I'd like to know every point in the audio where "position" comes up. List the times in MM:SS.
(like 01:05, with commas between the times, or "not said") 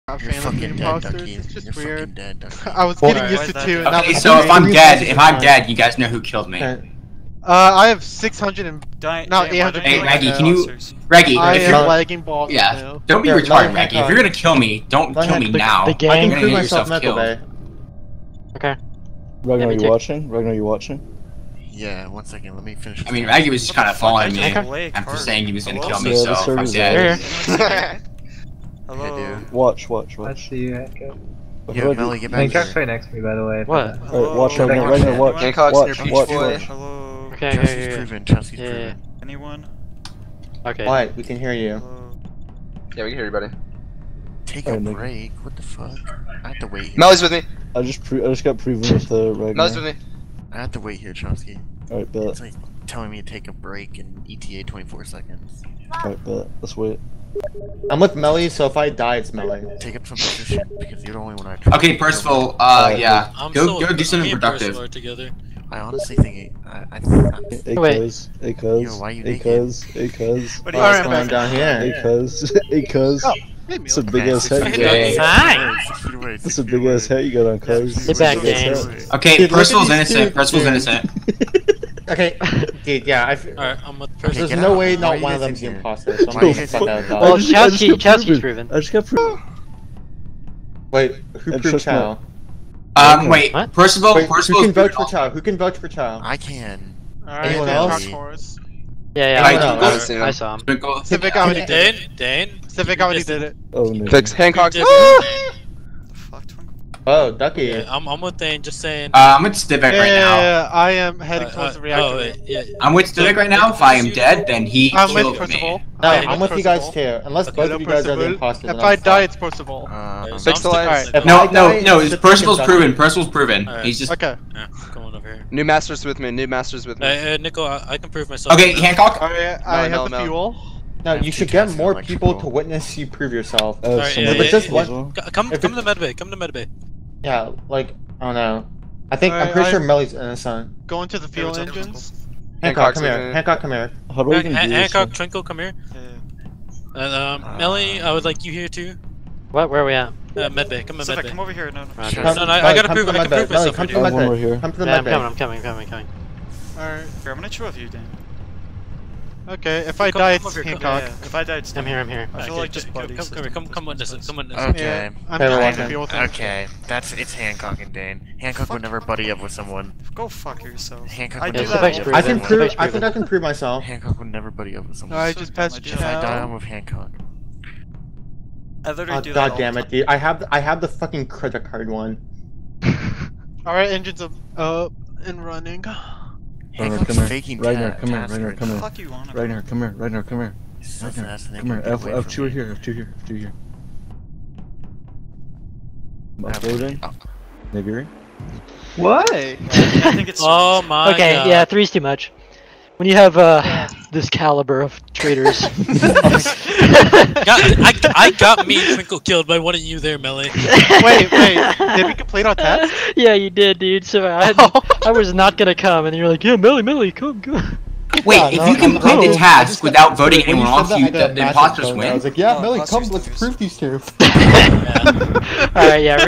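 01:00.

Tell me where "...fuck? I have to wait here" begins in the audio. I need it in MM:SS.
00:45.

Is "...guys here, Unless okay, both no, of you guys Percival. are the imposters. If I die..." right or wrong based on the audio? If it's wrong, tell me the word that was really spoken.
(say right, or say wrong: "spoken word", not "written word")
right.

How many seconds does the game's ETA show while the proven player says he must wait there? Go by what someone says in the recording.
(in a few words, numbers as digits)
24.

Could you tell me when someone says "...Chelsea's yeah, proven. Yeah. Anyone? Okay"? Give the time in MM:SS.
00:38.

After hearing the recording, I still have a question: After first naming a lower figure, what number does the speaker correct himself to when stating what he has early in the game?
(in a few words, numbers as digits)
800.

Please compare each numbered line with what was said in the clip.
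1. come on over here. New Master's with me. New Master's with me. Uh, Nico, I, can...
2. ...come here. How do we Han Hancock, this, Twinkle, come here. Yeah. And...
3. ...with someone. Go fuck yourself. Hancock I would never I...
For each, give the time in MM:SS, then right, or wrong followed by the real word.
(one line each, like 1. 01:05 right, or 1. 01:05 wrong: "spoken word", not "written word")
1. 02:04 right
2. 02:23 right
3. 02:49 right.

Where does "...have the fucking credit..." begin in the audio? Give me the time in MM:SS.
03:00.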